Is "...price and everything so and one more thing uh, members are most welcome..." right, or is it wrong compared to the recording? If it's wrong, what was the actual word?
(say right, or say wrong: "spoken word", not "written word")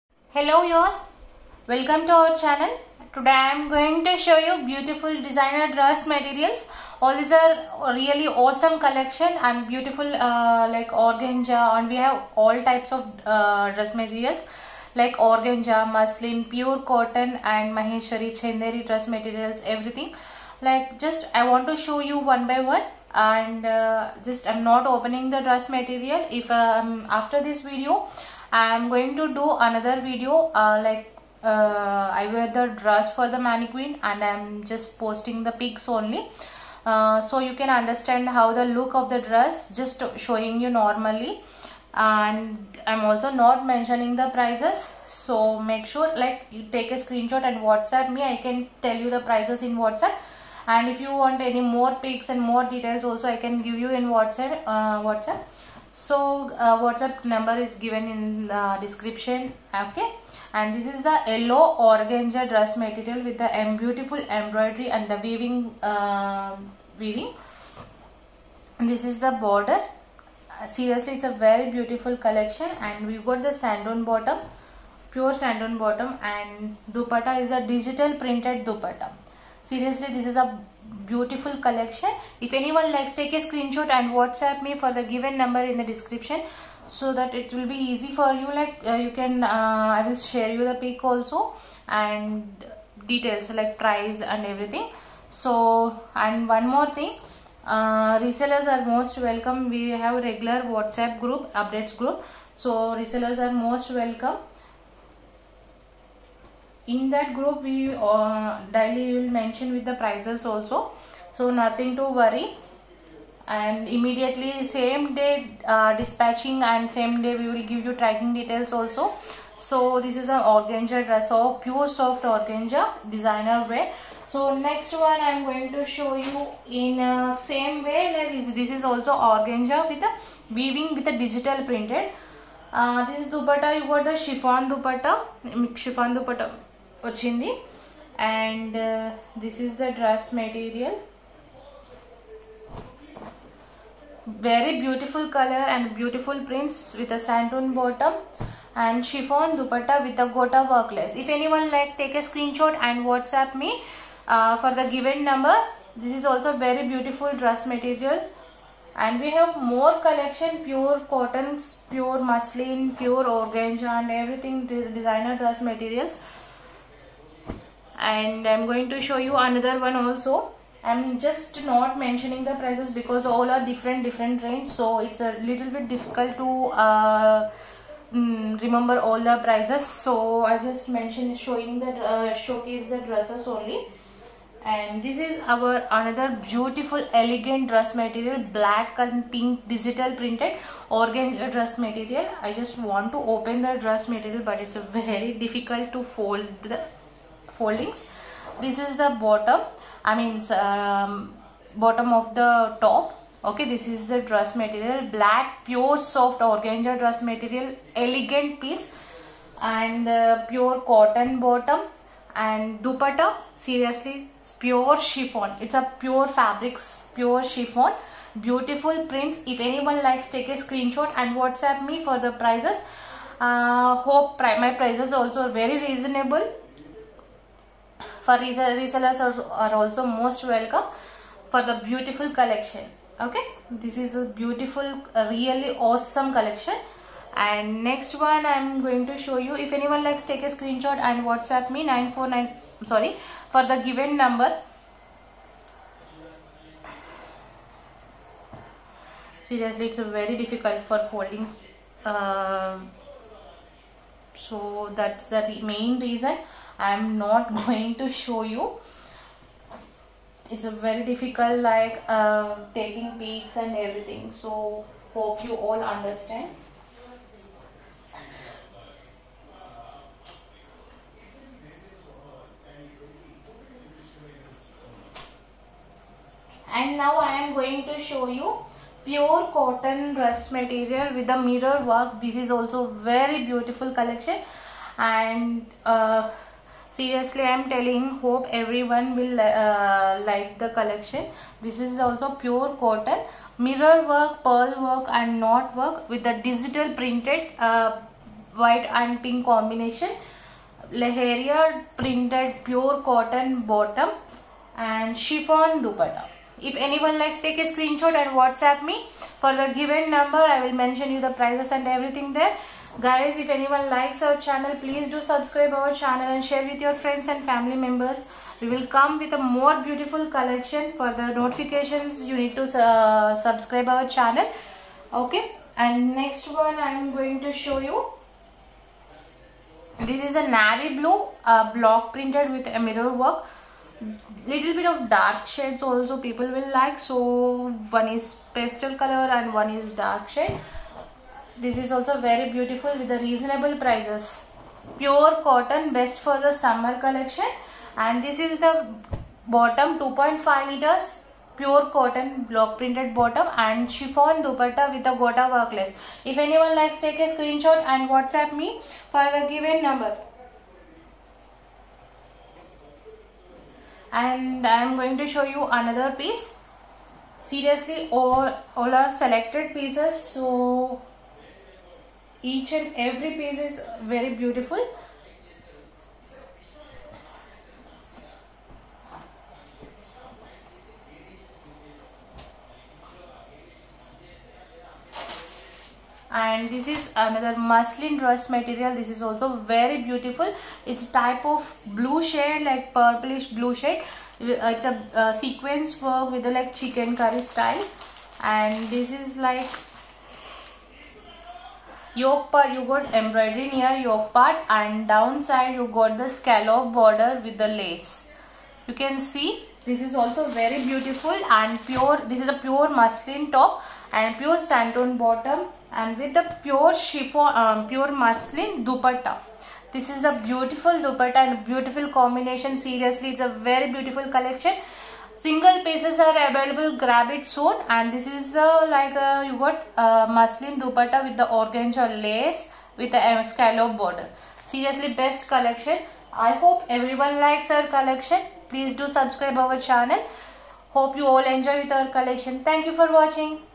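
wrong: "resellers", not "members".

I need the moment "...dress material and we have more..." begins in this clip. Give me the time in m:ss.
2:37.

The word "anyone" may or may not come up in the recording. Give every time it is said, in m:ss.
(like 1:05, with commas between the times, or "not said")
1:22, 2:31, 3:39, 3:59, 5:06, 5:13, 5:56.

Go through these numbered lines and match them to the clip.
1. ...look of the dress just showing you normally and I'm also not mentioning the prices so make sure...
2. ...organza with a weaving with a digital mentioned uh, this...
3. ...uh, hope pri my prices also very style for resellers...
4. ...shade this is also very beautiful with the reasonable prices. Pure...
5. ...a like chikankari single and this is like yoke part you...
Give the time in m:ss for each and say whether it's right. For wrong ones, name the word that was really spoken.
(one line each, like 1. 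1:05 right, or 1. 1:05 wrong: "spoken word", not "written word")
1. 0:38 right
2. 2:09 wrong: "printed", not "mentioned"
3. 3:43 wrong: "reasonable", not "style"
4. 5:40 right
5. 6:36 wrong: "style", not "single".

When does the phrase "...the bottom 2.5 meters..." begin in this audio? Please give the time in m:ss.
5:48.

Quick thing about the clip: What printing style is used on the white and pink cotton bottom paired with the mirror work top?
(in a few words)
Leharia.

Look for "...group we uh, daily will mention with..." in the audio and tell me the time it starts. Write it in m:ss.
1:47.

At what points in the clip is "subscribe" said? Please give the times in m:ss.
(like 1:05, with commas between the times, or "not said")
5:15, 5:23, 7:19.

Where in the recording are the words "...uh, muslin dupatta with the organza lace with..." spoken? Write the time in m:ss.
7:09.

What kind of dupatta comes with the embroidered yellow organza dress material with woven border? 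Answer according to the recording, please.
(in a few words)
Digital printed dupatta.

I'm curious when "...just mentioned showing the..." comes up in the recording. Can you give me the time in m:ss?
3:00.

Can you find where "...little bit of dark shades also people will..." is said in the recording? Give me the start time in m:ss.
5:34.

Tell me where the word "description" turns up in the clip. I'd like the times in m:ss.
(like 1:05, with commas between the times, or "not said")
0:58, 1:25.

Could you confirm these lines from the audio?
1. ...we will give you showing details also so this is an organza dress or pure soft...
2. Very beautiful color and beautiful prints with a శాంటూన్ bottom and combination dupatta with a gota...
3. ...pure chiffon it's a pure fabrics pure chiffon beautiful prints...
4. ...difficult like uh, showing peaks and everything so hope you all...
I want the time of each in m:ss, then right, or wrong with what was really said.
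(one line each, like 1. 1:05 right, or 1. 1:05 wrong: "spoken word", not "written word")
1. 1:57 wrong: "tracking", not "showing"
2. 2:24 wrong: "chiffon", not "combination"
3. 3:34 right
4. 4:21 wrong: "taking", not "showing".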